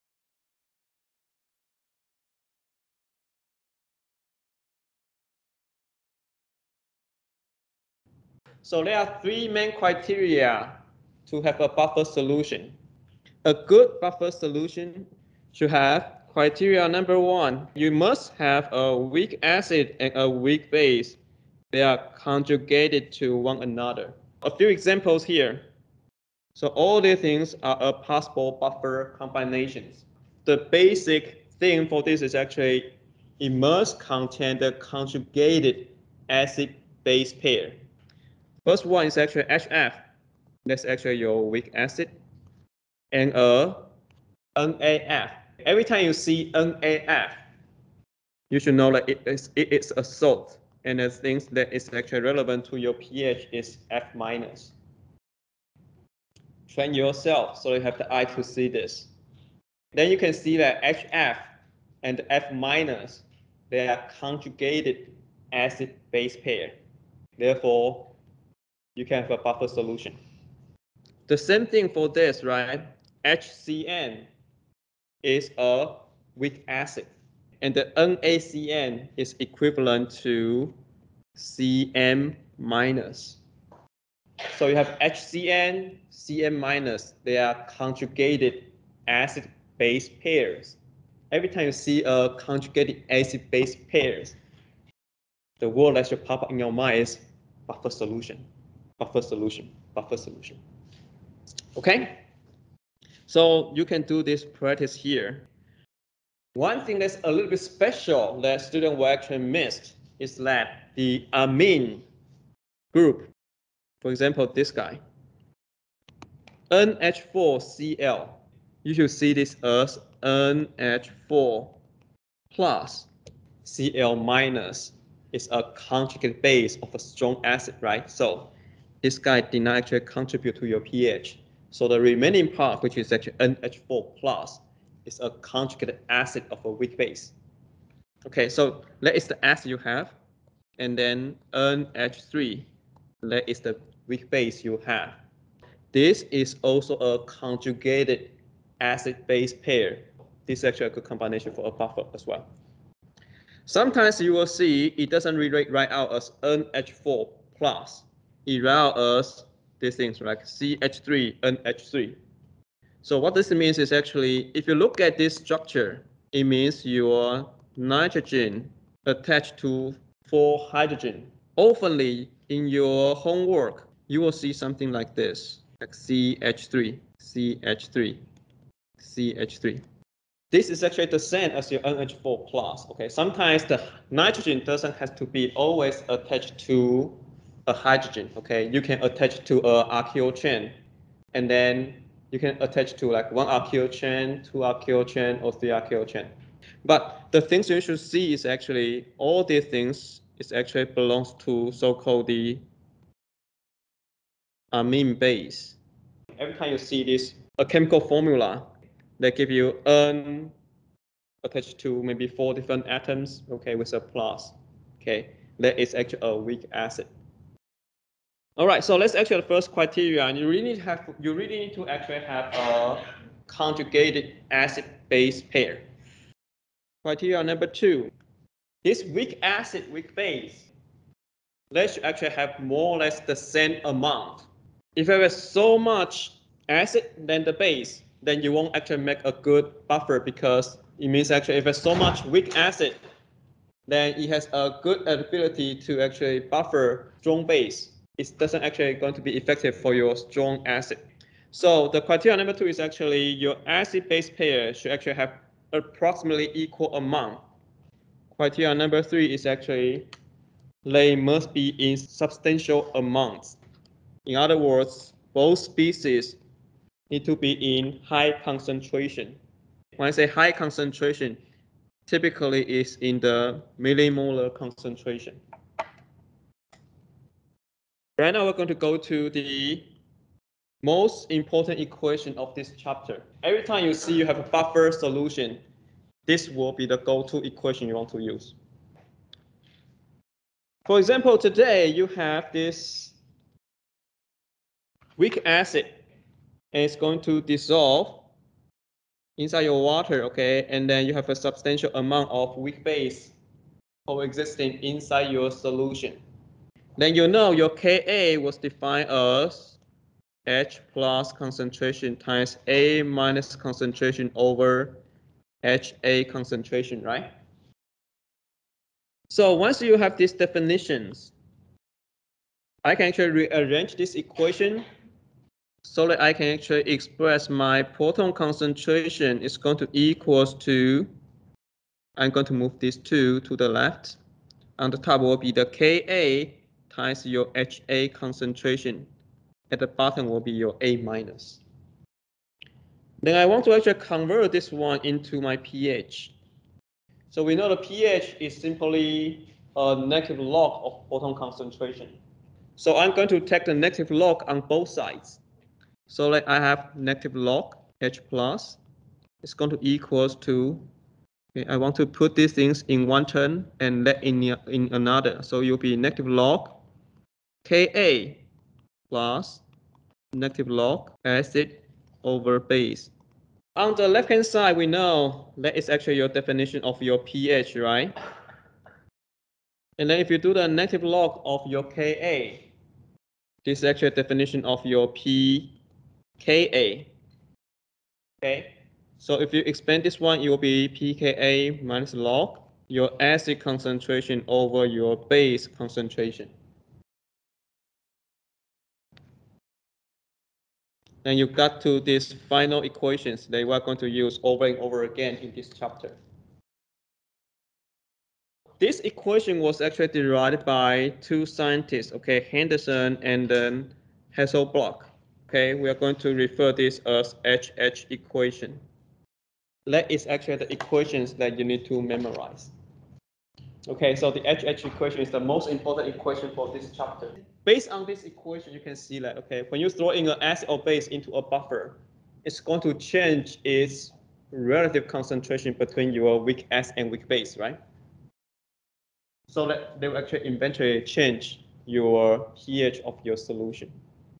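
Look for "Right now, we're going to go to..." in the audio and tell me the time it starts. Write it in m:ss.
4:38.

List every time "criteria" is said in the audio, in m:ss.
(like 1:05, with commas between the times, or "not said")
0:09, 0:16, 3:39, 3:47, 4:12, 4:18.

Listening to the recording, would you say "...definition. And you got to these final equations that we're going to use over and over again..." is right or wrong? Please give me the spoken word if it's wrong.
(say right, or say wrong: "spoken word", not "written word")
wrong: "concentration", not "definition".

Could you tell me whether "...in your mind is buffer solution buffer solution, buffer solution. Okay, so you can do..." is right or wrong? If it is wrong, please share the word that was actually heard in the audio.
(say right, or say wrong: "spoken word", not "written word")
right.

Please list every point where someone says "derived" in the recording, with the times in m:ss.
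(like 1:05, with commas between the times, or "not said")
6:50.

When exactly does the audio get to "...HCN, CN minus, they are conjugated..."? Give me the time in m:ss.
1:25.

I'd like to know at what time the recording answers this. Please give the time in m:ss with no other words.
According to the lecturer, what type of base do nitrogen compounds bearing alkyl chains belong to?
3:24.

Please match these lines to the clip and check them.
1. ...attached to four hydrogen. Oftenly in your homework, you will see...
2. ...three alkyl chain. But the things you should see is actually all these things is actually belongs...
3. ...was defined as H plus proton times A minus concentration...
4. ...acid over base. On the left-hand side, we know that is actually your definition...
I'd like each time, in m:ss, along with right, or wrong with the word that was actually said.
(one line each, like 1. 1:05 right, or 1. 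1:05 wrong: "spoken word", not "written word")
1. 2:49 right
2. 3:15 right
3. 5:08 wrong: "concentration", not "proton"
4. 6:11 right.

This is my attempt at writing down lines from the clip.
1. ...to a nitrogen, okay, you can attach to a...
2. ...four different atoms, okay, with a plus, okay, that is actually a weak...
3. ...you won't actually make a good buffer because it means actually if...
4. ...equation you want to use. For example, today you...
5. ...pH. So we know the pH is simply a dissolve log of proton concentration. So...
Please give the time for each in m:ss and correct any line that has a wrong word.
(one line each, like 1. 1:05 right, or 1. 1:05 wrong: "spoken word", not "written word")
1. 3:06 wrong: "hydrogen", not "nitrogen"
2. 3:32 right
3. 3:58 right
4. 4:47 right
5. 5:45 wrong: "negative", not "dissolve".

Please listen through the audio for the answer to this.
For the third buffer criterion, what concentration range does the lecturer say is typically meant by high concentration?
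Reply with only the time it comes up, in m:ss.
4:33.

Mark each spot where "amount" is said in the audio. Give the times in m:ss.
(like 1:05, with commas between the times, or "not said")
3:53, 4:16, 4:22, 5:01.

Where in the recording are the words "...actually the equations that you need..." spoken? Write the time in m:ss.
7:00.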